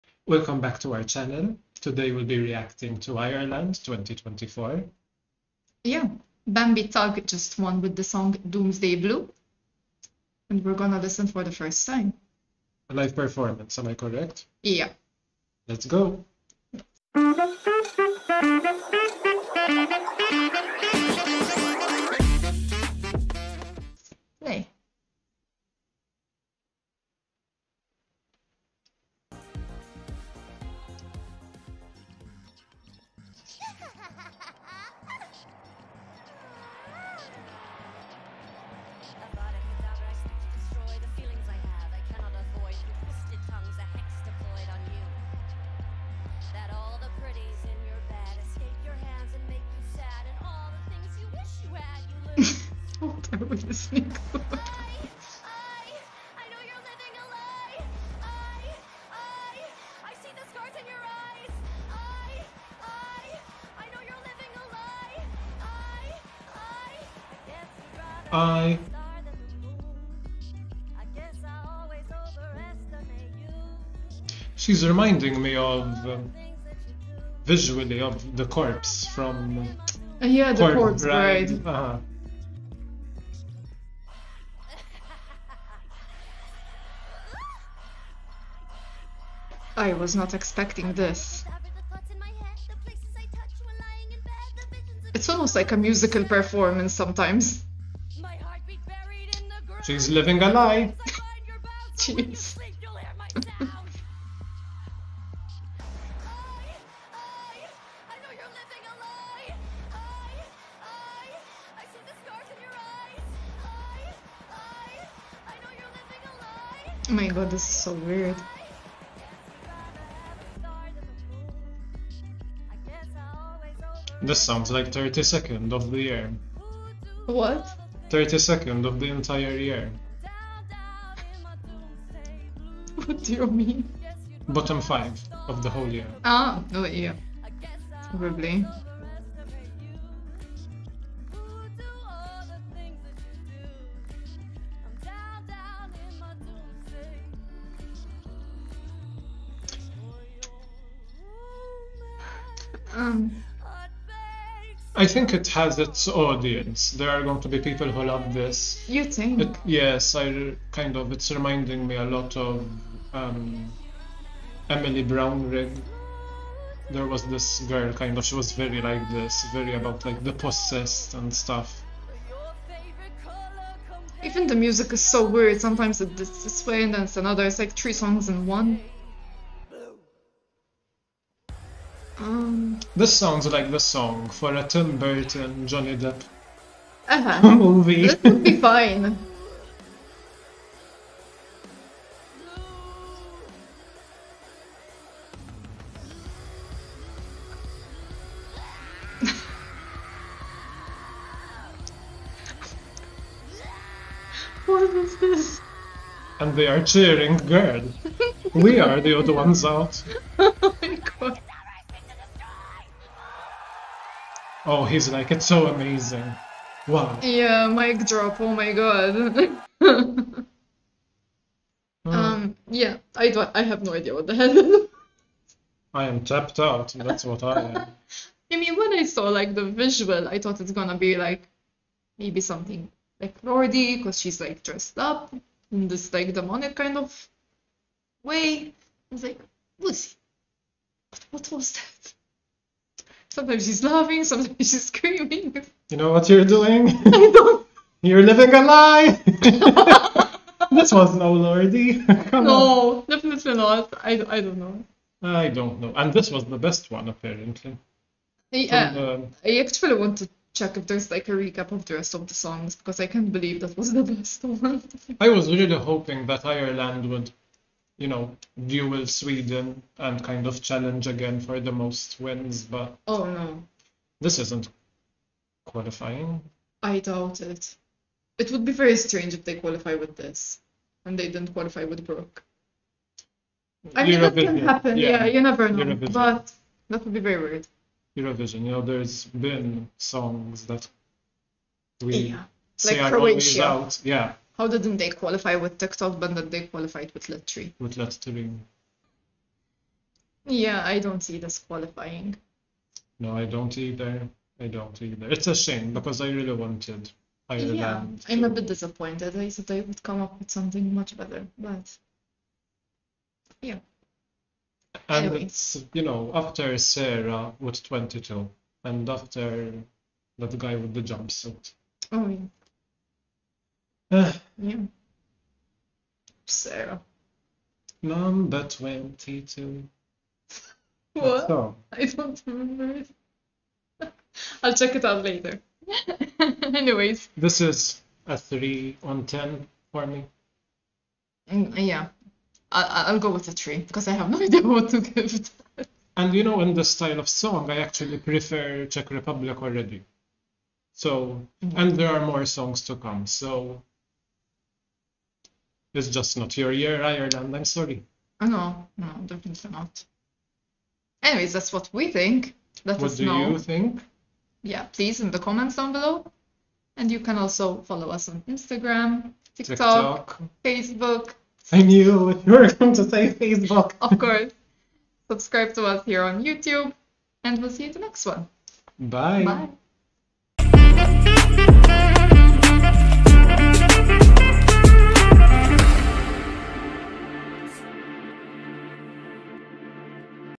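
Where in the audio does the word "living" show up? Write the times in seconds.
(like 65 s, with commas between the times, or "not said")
100 s, 248 s.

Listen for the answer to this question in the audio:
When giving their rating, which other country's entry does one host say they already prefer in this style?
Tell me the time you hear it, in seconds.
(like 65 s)
348 s.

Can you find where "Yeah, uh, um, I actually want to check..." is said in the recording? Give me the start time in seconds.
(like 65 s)
258 s.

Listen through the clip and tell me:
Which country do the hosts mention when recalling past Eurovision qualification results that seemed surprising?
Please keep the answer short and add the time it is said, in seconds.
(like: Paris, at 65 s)
Croatia, at 293 s.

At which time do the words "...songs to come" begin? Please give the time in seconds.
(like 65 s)
352 s.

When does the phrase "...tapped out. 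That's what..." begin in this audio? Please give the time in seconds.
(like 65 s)
226 s.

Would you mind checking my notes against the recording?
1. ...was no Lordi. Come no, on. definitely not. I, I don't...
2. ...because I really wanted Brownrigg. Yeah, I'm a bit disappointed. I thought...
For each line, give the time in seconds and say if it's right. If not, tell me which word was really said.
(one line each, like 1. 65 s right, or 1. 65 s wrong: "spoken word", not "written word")
1. 250 s right
2. 305 s wrong: "Ireland", not "Brownrigg".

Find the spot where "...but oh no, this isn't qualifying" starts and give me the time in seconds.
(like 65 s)
272 s.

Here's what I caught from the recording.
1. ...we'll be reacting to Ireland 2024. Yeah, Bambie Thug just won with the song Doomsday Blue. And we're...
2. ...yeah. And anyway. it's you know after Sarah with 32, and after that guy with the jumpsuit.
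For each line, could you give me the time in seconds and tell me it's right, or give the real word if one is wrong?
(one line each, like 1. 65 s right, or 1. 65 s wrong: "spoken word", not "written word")
1. 2 s right
2. 313 s wrong: "22", not "32".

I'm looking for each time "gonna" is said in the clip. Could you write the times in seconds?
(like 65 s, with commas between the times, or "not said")
10 s, 230 s.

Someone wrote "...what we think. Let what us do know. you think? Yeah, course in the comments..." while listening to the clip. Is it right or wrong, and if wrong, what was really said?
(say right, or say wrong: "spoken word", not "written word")
wrong: "please", not "course".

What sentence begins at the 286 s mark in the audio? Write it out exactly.
But that would be very weird.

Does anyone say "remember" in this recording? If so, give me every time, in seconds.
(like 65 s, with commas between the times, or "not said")
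332 s.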